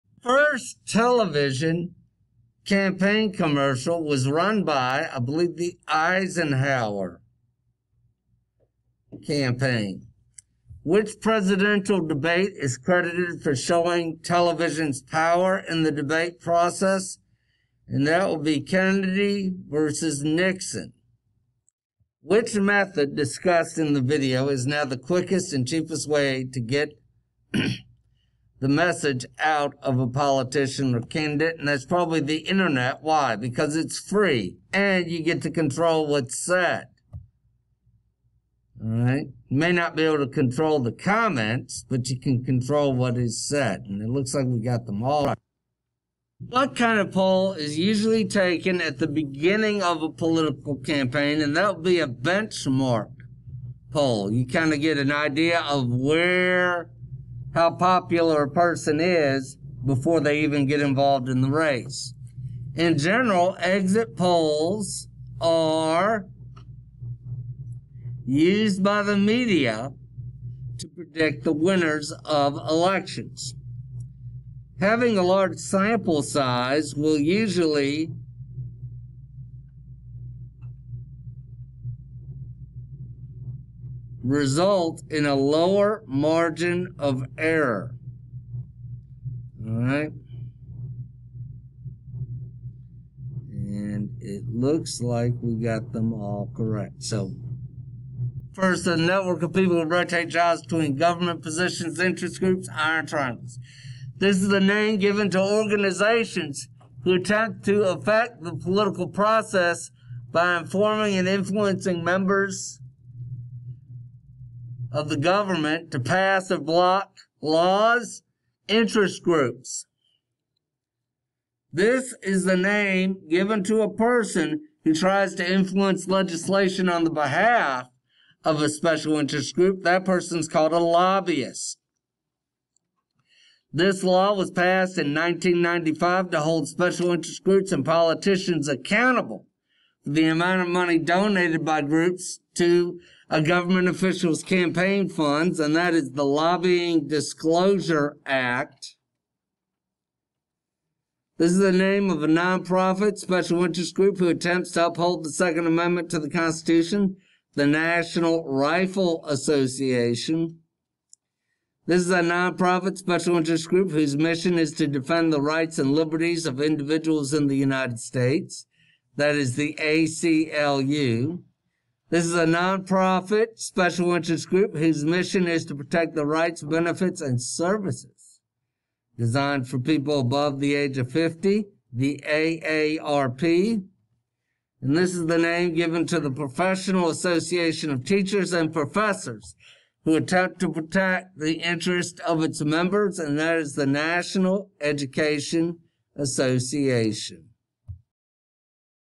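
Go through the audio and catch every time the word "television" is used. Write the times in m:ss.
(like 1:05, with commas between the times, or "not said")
0:00, 0:14.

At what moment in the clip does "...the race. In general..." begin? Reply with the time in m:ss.
1:01.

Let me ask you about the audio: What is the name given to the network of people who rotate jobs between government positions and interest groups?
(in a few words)
iron triangles.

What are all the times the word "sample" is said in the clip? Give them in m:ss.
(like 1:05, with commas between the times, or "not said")
1:15.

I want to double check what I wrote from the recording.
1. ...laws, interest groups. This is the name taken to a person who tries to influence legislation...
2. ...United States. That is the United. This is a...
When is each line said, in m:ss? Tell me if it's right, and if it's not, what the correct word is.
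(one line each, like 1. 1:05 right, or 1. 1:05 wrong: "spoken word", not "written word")
1. 1:57 wrong: "given", not "taken"
2. 2:47 wrong: "ACLU", not "United".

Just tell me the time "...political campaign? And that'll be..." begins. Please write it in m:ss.
0:50.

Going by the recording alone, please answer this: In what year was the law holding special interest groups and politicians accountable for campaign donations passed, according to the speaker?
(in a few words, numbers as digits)
1995.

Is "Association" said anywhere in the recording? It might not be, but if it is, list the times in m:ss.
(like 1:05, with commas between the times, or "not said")
2:39, 3:07, 3:16.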